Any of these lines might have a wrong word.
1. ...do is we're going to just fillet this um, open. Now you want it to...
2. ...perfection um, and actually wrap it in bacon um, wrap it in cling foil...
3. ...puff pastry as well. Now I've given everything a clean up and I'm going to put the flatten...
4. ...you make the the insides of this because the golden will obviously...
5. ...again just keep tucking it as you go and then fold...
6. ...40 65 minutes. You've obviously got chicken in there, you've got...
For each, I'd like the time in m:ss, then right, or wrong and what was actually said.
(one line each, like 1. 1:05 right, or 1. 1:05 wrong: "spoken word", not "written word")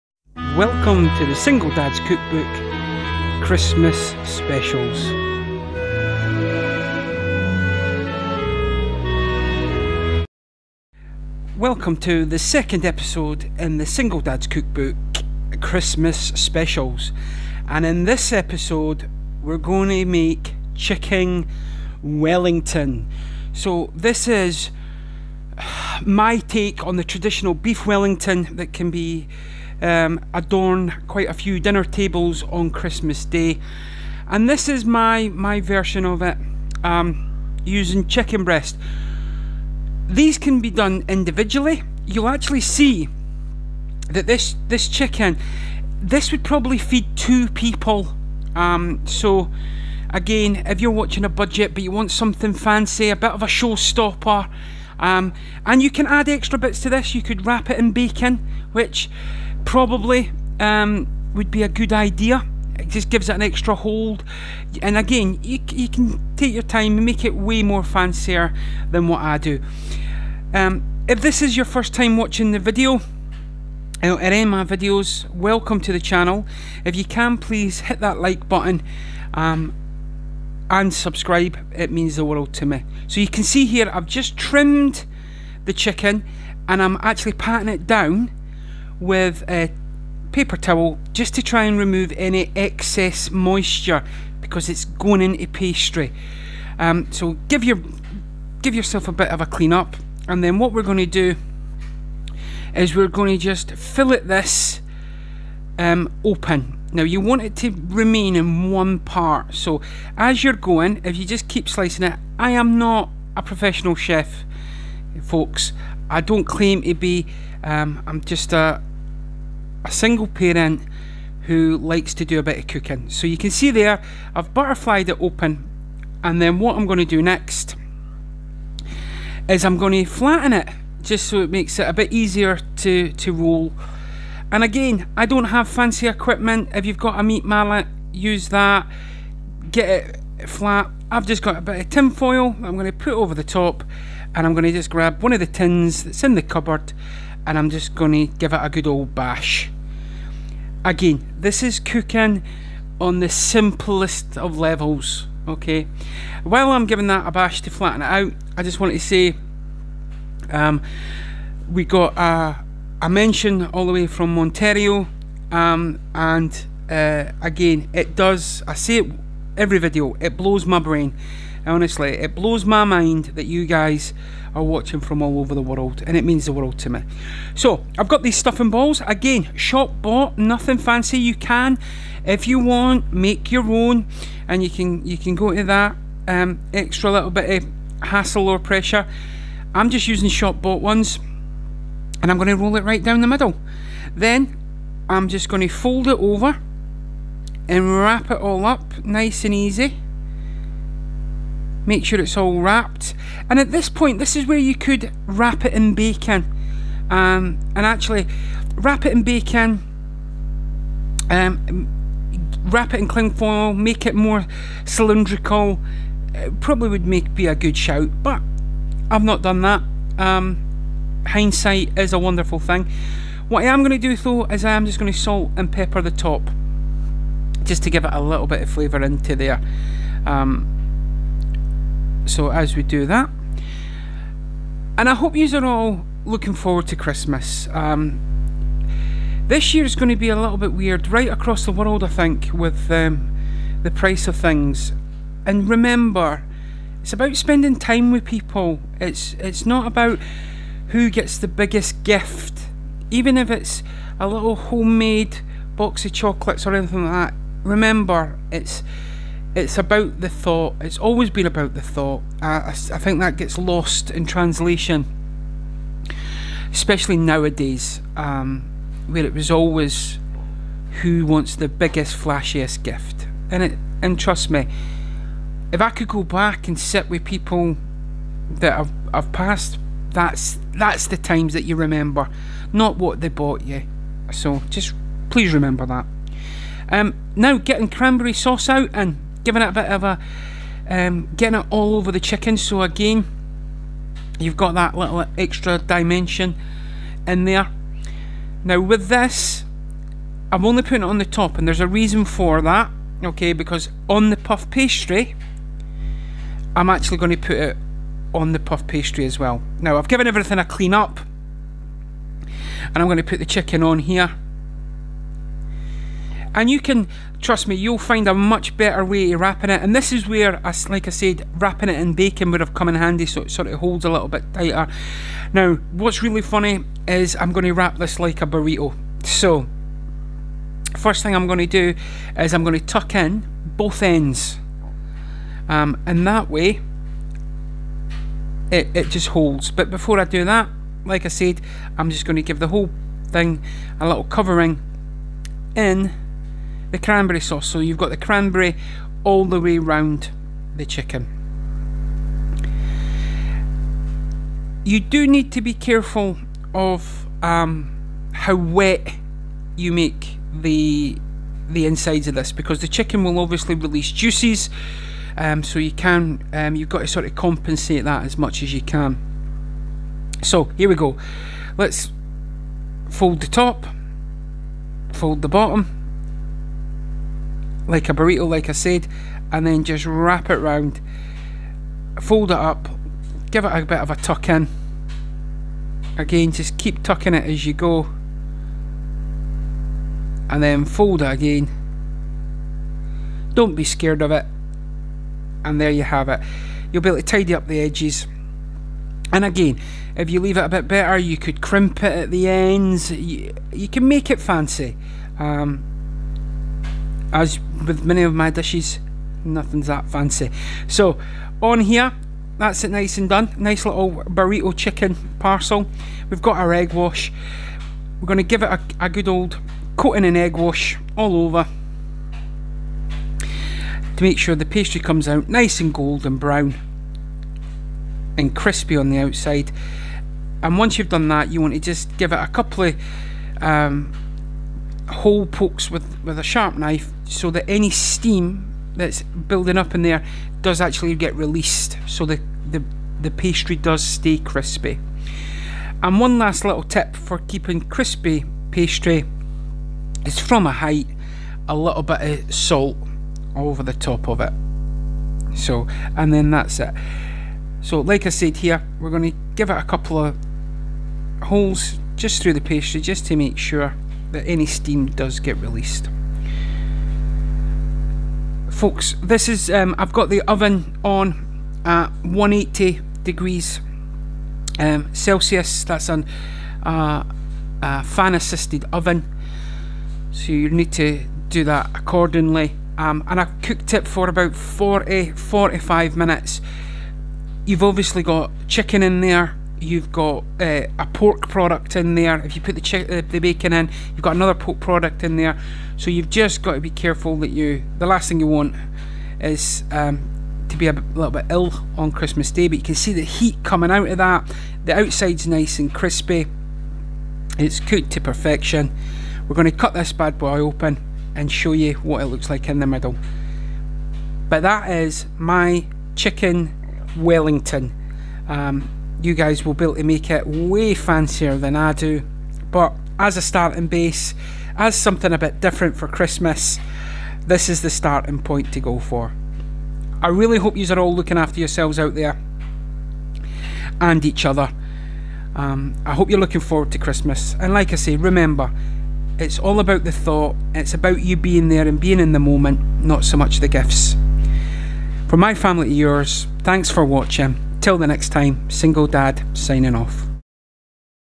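1. 1:41 right
2. 3:25 wrong: "bacon", not "perfection"
3. 5:08 wrong: "chicken", not "flatten"
4. 5:59 wrong: "chicken", not "golden"
5. 6:26 right
6. 8:04 wrong: "45", not "65".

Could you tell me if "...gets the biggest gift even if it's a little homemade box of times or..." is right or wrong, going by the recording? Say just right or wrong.
wrong.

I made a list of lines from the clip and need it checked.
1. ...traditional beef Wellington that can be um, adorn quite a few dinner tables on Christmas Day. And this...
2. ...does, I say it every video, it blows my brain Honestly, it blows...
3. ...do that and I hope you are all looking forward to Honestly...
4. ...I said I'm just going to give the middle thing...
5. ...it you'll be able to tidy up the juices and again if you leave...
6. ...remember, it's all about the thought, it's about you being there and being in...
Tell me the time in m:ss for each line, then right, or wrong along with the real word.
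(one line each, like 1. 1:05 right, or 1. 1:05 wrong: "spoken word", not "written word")
1. 0:27 right
2. 2:48 right
3. 3:52 wrong: "Christmas", not "Honestly"
4. 5:41 wrong: "whole", not "middle"
5. 6:36 wrong: "edges", not "juices"
6. 8:58 right.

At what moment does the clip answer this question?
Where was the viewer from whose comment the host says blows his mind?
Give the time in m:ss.
2:44.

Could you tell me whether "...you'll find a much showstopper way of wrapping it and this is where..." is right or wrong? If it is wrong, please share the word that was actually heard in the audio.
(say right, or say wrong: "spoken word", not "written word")
wrong: "better", not "showstopper".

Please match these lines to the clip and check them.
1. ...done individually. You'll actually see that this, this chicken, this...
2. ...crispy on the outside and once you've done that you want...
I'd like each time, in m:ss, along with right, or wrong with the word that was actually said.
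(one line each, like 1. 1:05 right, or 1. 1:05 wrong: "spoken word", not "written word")
1. 0:40 right
2. 7:08 right.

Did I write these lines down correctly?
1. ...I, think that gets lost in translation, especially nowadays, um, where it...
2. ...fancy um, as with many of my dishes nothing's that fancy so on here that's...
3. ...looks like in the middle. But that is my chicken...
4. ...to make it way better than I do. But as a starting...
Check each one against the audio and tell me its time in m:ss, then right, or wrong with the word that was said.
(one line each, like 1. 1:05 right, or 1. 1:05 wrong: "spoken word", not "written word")
1. 4:22 right
2. 6:44 right
3. 8:32 right
4. 8:39 wrong: "fancier", not "better".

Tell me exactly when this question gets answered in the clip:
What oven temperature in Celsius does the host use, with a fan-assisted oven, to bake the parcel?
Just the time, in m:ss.
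7:52.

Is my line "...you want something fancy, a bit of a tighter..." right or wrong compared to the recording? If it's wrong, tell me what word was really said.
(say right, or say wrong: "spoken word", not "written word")
wrong: "showstopper", not "tighter".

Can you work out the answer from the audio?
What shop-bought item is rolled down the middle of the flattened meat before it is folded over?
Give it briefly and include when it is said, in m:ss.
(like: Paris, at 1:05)
Stuffing balls, at 2:58.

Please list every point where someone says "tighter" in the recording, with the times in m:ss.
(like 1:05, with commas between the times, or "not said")
5:24.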